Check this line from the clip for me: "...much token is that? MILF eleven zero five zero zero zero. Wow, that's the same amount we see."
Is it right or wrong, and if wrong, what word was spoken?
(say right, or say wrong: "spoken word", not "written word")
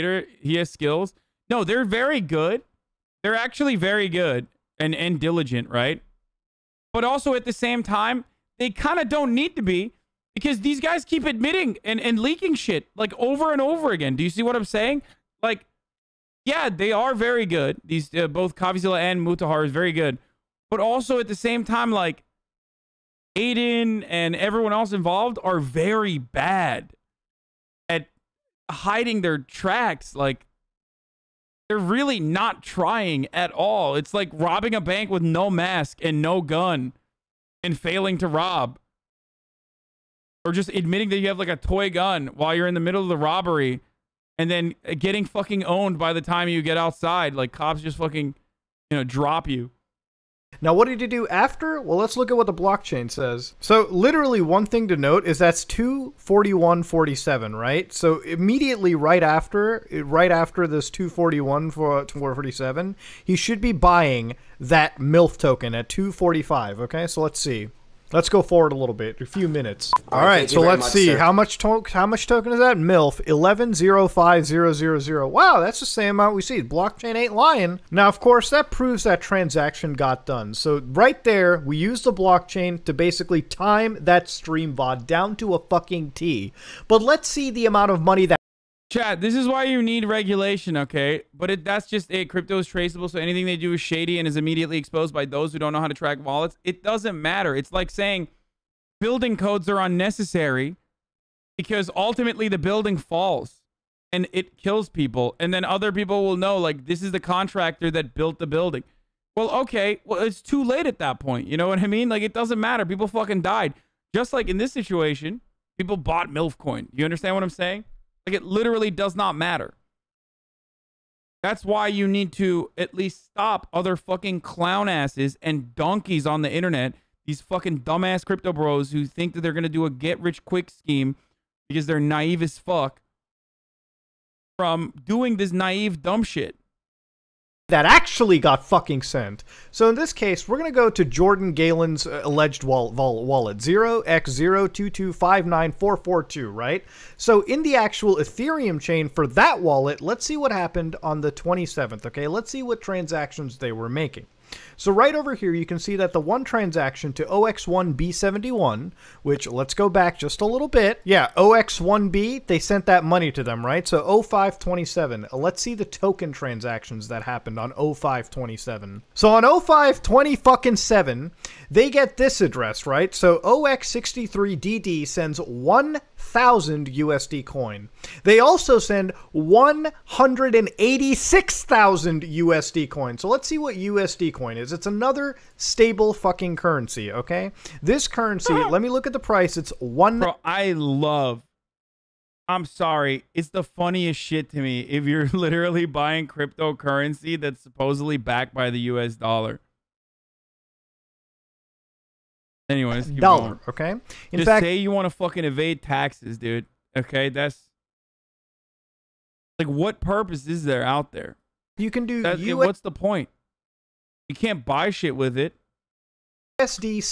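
right.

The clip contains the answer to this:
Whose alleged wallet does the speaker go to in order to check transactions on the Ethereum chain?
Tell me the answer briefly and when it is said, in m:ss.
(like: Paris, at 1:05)
Jordan Galen, at 2:21.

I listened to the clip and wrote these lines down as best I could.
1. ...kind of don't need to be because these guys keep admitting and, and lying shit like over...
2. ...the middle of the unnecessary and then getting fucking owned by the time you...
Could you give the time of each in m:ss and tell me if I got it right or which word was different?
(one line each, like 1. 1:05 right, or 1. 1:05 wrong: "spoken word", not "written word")
1. 0:08 wrong: "leaking", not "lying"
2. 0:42 wrong: "robbery", not "unnecessary".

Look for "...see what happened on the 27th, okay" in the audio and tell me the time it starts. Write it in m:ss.
2:30.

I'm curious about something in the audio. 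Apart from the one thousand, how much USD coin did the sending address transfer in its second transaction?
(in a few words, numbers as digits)
186,000.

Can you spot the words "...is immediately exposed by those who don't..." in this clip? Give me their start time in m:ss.
1:34.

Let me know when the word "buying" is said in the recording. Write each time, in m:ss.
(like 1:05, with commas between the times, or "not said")
1:03, 3:15.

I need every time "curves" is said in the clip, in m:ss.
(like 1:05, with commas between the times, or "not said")
not said.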